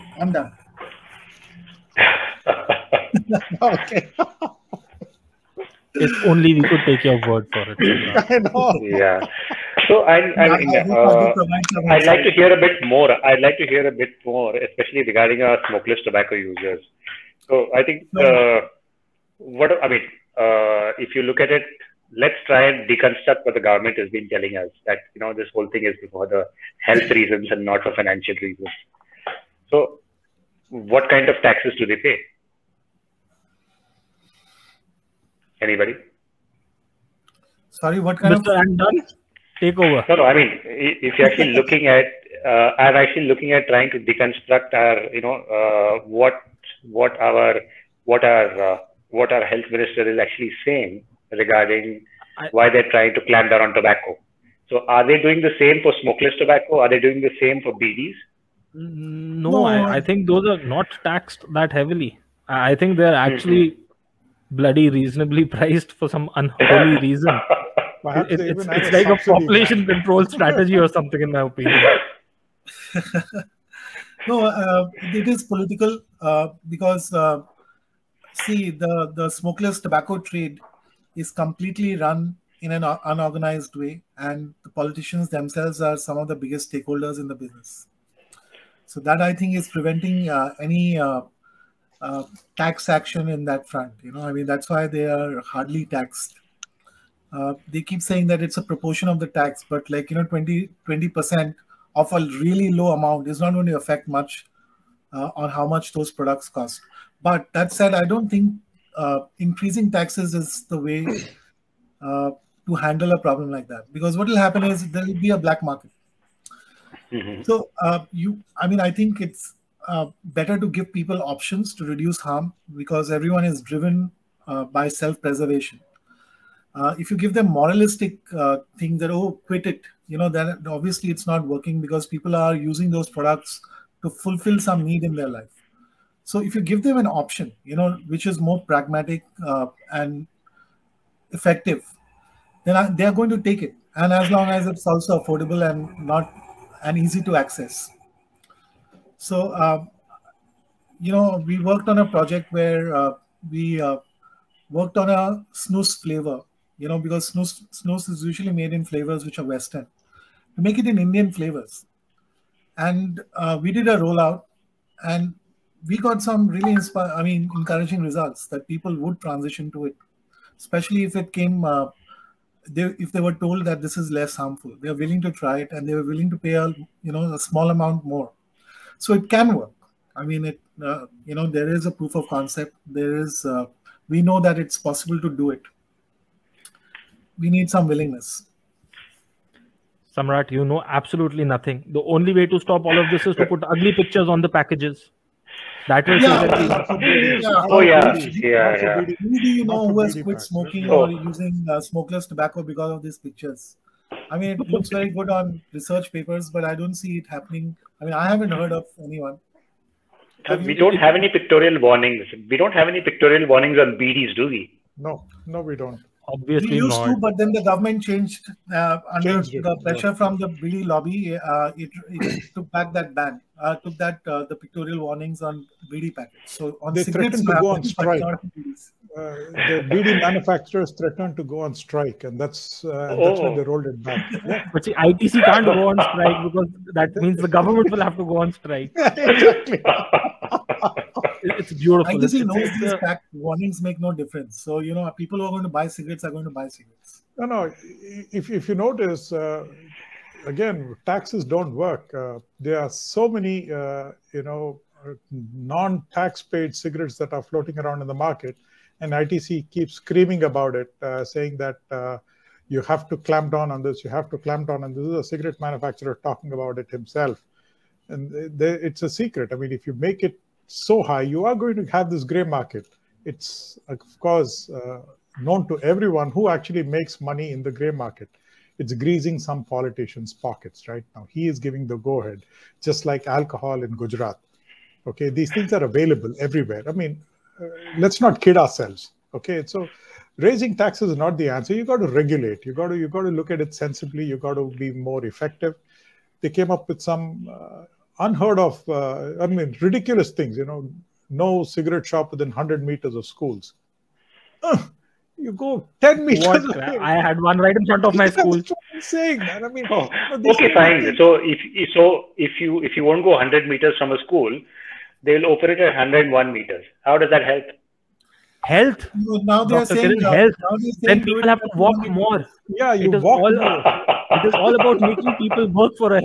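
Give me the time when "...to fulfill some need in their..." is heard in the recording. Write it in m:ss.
2:14.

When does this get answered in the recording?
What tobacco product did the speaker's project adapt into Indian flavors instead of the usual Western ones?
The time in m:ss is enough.
2:35.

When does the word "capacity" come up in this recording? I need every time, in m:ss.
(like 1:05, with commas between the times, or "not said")
not said.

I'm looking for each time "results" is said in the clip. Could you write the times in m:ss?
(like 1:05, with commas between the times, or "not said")
2:48.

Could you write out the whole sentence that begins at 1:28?
So that I think is preventing uh, any.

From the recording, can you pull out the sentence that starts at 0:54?
So, are they doing the same for smokeless tobacco?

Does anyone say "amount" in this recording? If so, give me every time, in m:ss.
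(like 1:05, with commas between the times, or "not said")
1:42, 2:57.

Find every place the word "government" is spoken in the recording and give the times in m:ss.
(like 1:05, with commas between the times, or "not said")
0:23, 3:37, 3:57.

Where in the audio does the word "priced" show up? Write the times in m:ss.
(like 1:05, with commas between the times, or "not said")
1:05.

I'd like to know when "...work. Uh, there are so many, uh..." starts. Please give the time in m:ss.
4:11.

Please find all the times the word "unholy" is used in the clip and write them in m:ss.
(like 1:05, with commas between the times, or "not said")
1:06.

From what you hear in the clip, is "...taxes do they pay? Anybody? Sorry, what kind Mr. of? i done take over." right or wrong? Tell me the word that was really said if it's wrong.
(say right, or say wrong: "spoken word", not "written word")
right.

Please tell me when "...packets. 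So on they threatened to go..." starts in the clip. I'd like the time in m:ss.
3:46.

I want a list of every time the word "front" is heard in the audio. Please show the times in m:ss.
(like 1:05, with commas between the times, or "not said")
1:33, 5:07.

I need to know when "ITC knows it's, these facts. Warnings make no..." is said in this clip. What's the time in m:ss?
4:02.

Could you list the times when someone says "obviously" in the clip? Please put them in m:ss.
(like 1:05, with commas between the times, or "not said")
2:10, 3:36.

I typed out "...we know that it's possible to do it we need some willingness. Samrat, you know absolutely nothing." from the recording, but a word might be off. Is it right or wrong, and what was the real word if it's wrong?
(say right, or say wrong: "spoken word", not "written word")
right.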